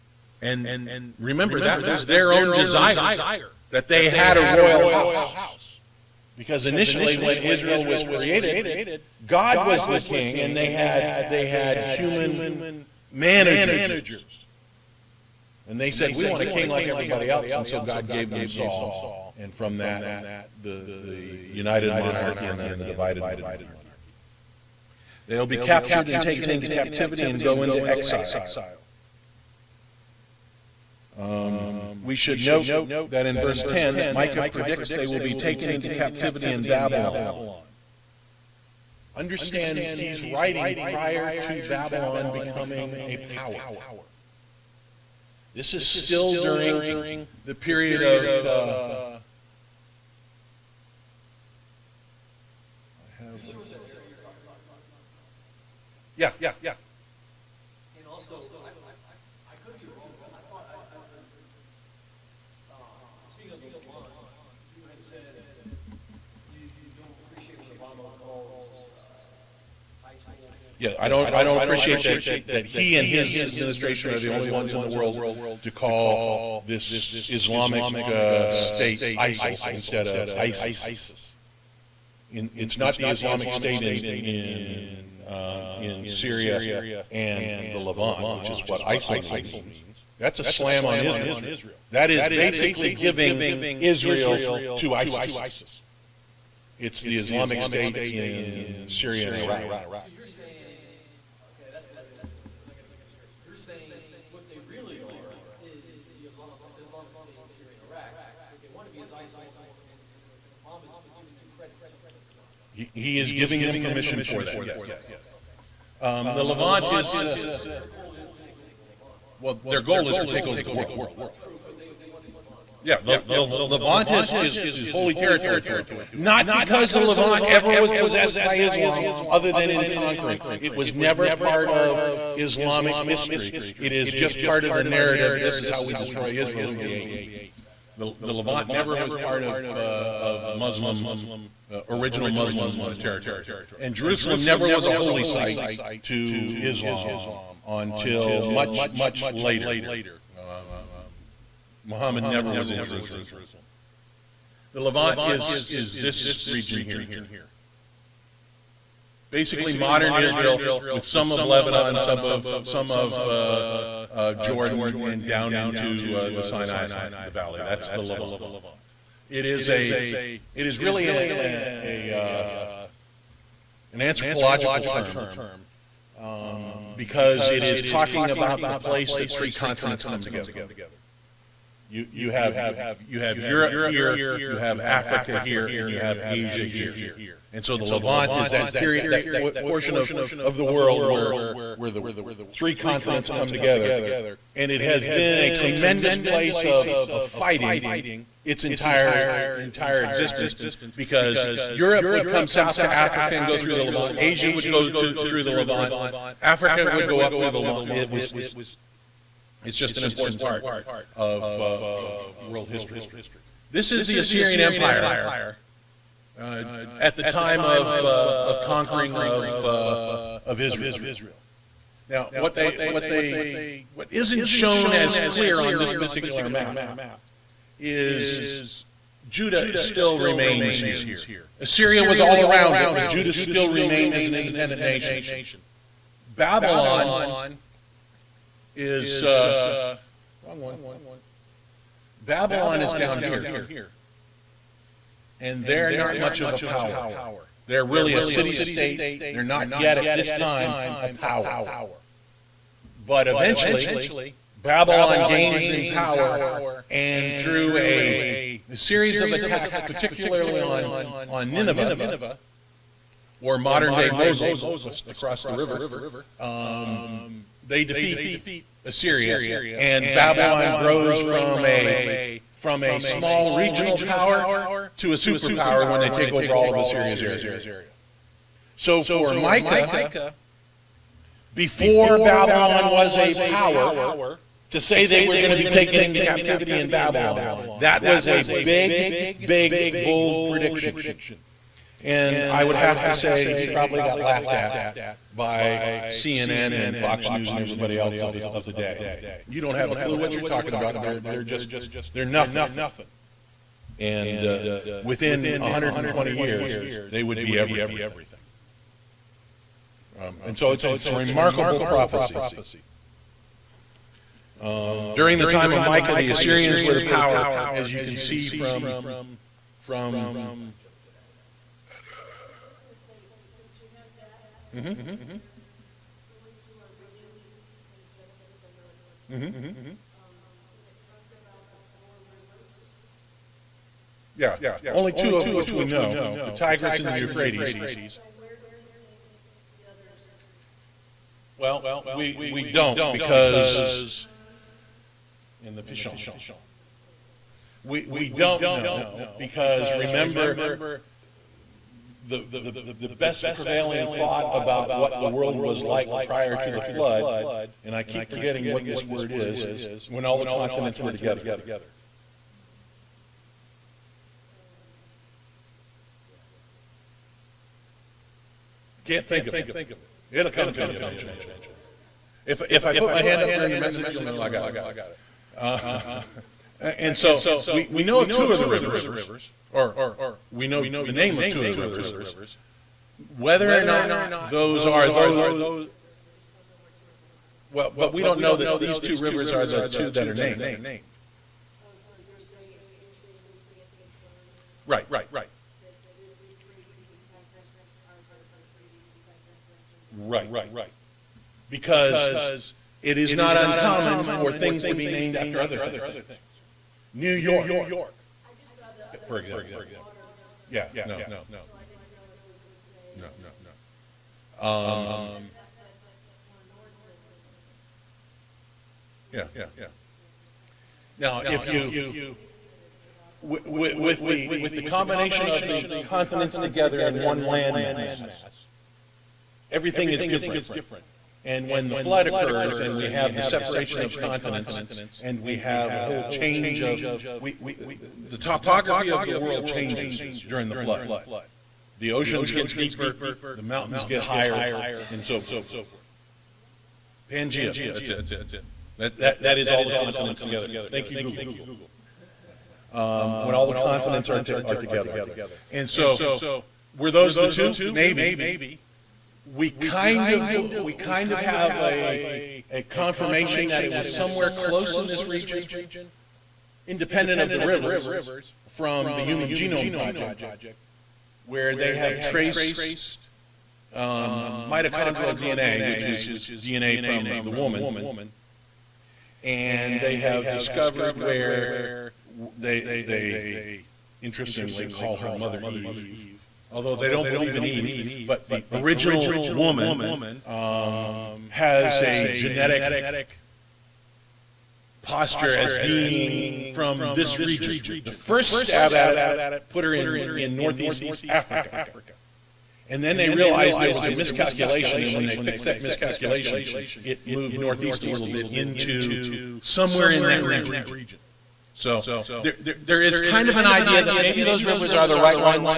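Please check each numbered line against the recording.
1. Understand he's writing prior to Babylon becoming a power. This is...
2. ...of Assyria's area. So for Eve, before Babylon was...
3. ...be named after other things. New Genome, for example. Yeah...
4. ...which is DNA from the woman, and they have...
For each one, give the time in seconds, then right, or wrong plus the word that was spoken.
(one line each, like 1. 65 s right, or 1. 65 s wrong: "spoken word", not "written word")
1. 39 s right
2. 276 s wrong: "Micah", not "Eve"
3. 404 s wrong: "York", not "Genome"
4. 475 s right.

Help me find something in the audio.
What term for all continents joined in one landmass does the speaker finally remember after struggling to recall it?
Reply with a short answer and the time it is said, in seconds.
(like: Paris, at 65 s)
Pangea, at 447 s.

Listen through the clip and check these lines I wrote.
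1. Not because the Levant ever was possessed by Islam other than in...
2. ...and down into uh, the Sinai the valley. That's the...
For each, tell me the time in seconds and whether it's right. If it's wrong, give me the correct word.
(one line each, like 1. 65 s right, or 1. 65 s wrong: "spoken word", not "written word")
1. 126 s right
2. 164 s right.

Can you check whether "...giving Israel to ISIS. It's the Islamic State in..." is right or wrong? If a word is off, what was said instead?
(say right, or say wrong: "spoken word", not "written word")
right.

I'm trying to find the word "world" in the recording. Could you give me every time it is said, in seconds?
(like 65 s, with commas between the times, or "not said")
74 s, 120 s, 190 s, 212 s, 355 s, 439 s.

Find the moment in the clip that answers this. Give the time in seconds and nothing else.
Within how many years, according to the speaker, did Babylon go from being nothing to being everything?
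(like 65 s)
305 s.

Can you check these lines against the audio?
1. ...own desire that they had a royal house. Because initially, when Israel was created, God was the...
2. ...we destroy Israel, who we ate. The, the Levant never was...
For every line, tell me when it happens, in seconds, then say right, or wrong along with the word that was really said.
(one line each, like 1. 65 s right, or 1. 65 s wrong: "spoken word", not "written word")
1. 2 s right
2. 135 s right.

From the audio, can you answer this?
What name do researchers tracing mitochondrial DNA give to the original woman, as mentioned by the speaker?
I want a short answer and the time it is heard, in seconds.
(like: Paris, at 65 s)
Mother Eve, at 485 s.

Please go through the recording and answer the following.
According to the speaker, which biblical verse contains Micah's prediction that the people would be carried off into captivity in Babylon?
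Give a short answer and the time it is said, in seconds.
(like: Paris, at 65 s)
Verse 10, at 33 s.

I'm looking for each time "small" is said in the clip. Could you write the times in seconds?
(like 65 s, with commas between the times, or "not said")
272 s.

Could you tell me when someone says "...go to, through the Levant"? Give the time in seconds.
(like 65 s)
204 s.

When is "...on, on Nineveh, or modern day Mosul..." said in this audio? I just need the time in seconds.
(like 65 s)
260 s.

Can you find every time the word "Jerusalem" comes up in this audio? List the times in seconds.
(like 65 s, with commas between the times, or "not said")
143 s, 152 s.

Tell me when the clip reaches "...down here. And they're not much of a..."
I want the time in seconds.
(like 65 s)
242 s.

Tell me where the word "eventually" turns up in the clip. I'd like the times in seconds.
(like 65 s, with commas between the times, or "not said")
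253 s, 370 s.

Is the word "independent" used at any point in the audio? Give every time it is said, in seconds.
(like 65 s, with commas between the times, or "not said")
234 s, 466 s.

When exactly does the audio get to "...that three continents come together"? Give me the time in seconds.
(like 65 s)
179 s.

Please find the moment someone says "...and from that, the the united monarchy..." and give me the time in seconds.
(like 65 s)
19 s.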